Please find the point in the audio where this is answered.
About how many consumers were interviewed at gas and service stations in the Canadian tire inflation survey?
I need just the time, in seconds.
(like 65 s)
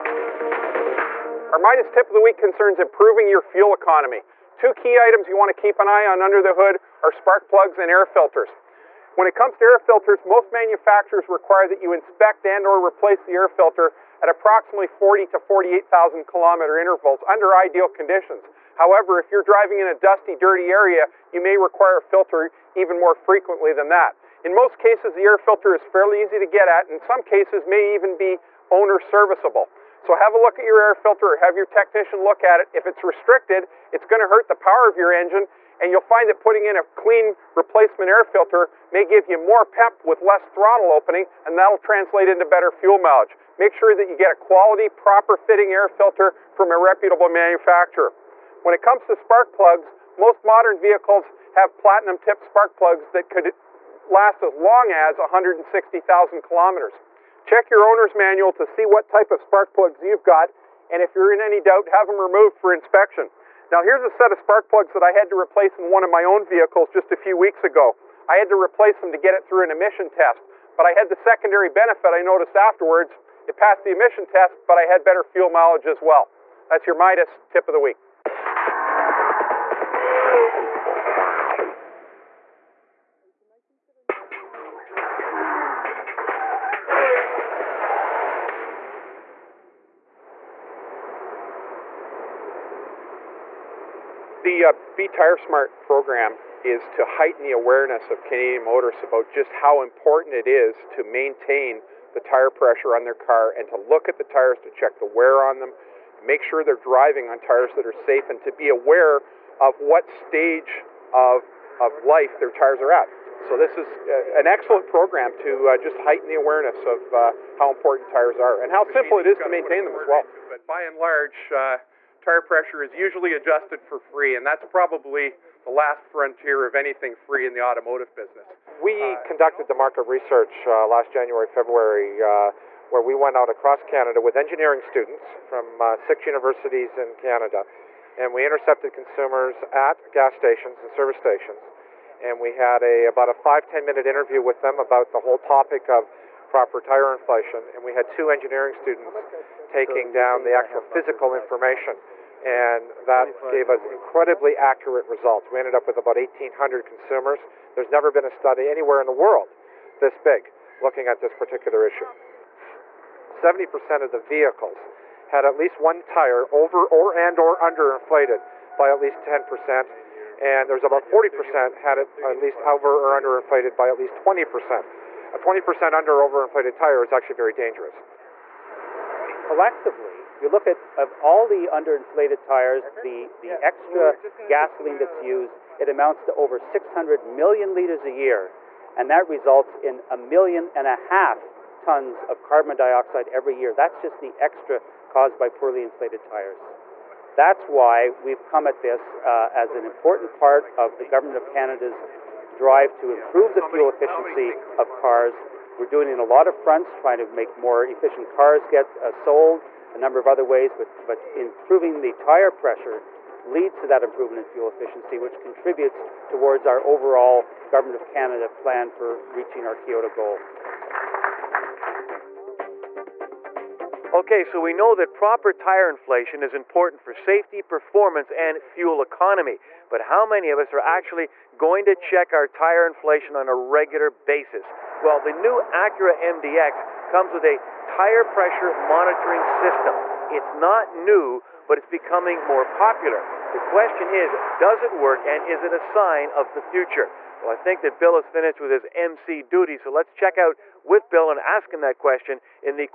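156 s.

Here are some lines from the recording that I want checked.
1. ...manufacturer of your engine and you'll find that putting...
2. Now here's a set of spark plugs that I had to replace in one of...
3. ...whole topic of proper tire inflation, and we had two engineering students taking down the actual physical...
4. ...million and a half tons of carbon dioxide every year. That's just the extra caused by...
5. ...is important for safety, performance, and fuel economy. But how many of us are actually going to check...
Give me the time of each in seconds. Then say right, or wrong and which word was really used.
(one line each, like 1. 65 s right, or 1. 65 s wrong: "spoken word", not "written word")
1. 34 s wrong: "power", not "manufacturer"
2. 63 s right
3. 145 s right
4. 190 s right
5. 226 s right.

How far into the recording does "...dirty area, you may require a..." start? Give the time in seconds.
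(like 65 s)
20 s.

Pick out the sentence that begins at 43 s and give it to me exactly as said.
Make sure that you get a quality, proper fitting air filter from a reputable manufacturer.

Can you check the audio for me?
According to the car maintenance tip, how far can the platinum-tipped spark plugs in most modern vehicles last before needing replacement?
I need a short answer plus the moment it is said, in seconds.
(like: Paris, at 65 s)
160,000 kilometers, at 55 s.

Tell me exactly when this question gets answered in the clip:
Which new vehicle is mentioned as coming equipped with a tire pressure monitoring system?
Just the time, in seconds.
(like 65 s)
235 s.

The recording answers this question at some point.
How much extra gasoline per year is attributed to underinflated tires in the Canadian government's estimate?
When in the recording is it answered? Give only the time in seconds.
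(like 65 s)
186 s.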